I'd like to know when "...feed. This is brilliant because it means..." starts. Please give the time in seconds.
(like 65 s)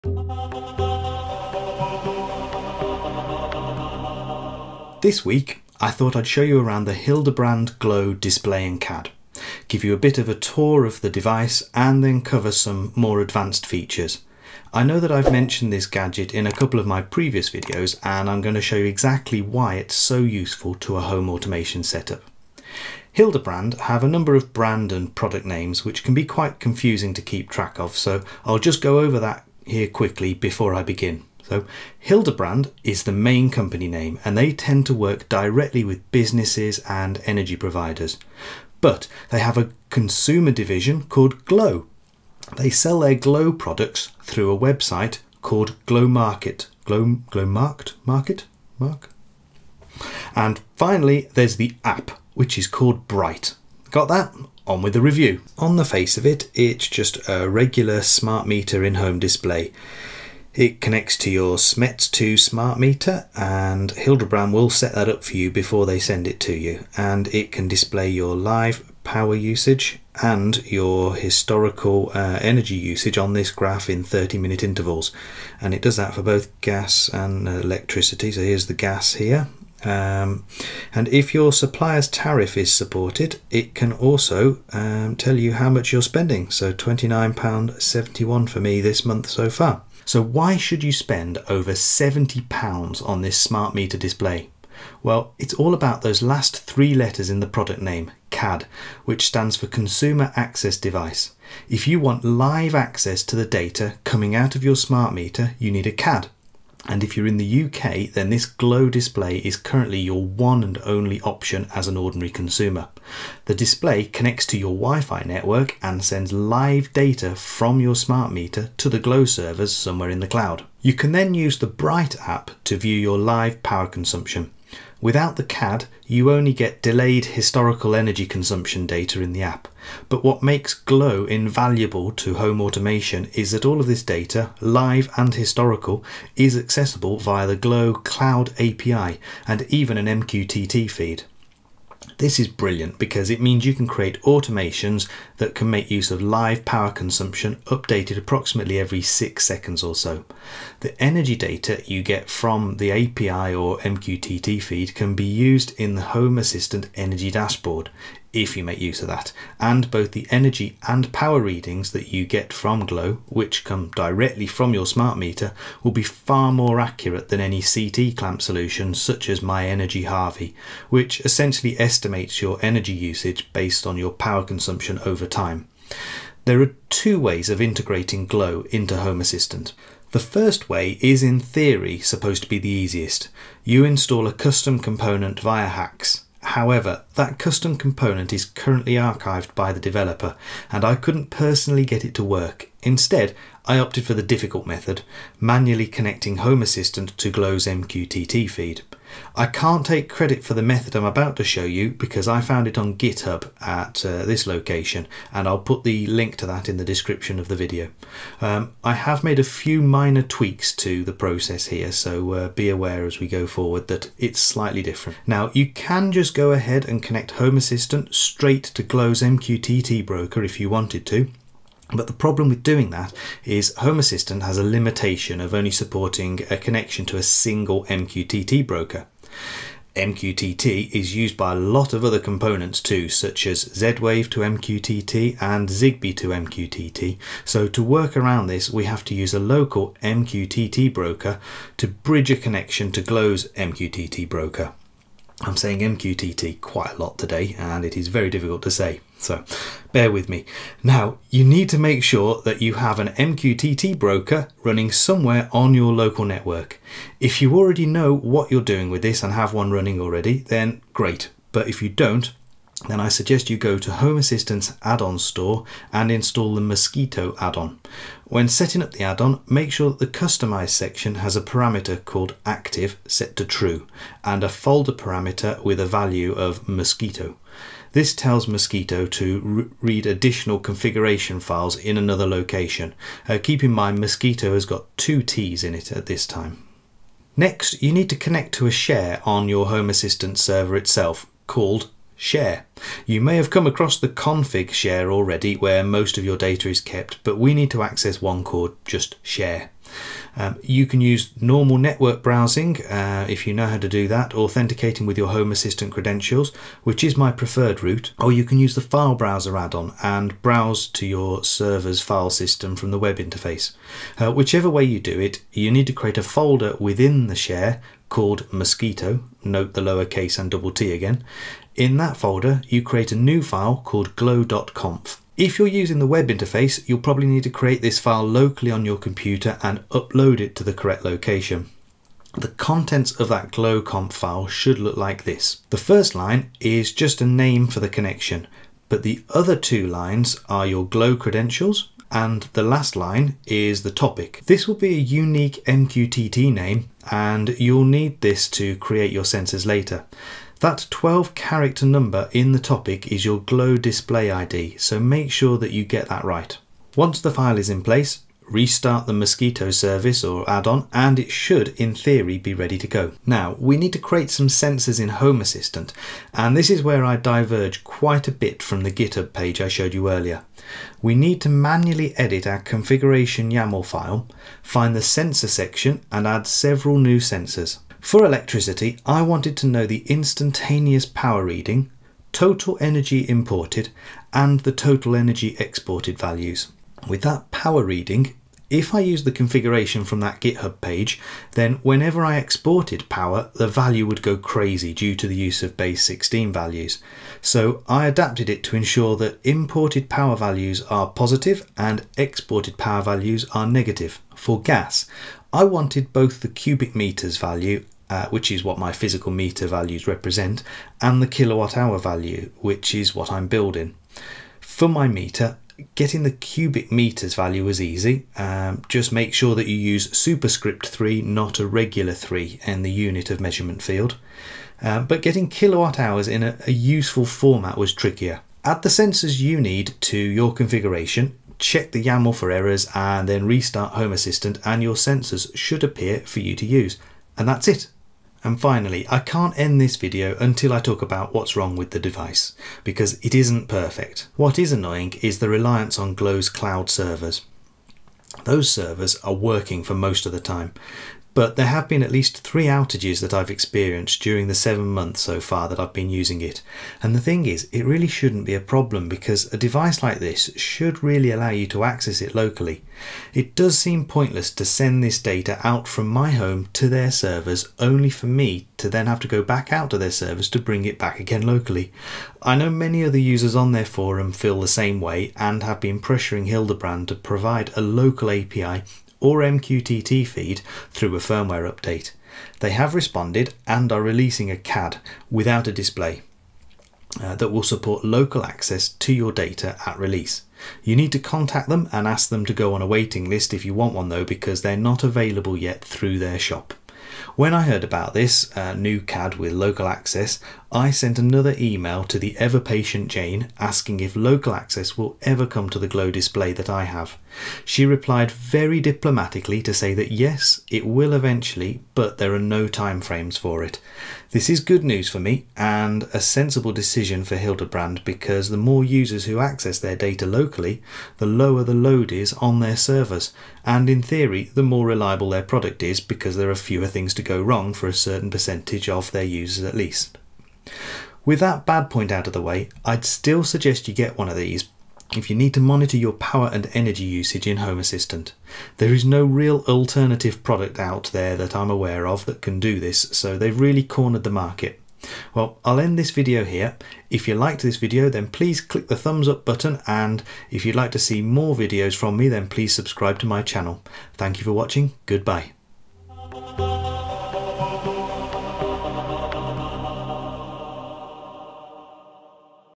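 140 s.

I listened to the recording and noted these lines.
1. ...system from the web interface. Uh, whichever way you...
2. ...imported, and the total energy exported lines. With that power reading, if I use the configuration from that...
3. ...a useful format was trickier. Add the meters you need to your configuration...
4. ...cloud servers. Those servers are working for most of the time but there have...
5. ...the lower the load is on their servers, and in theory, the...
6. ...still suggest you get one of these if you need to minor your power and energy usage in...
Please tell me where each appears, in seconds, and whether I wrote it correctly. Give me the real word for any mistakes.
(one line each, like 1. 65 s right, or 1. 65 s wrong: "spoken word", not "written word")
1. 312 s right
2. 383 s wrong: "values", not "lines"
3. 426 s wrong: "sensors", not "meters"
4. 446 s right
5. 521 s right
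6. 533 s wrong: "monitor", not "minor".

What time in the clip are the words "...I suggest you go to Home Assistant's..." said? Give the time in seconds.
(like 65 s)
262 s.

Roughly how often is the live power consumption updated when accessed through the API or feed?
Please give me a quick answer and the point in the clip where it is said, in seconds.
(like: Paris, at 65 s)
every 6 seconds, at 148 s.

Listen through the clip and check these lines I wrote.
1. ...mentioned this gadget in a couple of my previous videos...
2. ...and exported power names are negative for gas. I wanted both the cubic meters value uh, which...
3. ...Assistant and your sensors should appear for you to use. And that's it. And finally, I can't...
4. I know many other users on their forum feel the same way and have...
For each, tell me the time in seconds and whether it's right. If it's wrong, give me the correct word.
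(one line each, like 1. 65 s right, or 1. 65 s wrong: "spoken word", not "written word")
1. 15 s right
2. 401 s wrong: "values", not "names"
3. 434 s right
4. 472 s right.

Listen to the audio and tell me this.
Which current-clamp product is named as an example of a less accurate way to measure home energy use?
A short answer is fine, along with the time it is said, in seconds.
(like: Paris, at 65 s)
myenergi Harvi, at 169 s.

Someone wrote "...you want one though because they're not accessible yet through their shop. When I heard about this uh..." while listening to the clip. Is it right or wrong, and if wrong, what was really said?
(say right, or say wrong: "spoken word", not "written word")
wrong: "available", not "accessible".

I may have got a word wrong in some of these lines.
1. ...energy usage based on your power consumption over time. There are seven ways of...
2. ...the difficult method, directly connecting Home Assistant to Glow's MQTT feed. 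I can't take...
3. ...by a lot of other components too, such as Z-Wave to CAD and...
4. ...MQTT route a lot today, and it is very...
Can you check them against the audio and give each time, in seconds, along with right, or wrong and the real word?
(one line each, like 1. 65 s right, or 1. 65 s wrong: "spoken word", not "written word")
1. 172 s wrong: "two", not "seven"
2. 194 s wrong: "manually", not "directly"
3. 231 s wrong: "MQTT", not "CAD"
4. 245 s wrong: "quite", not "route".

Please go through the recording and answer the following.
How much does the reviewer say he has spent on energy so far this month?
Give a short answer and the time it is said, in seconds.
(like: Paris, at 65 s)
£29.71, at 86 s.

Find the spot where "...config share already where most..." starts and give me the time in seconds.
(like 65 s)
294 s.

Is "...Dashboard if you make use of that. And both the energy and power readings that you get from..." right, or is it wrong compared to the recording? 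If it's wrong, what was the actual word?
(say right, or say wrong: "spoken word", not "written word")
right.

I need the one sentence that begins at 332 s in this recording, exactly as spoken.
The contents of that glow.conf file should look like this.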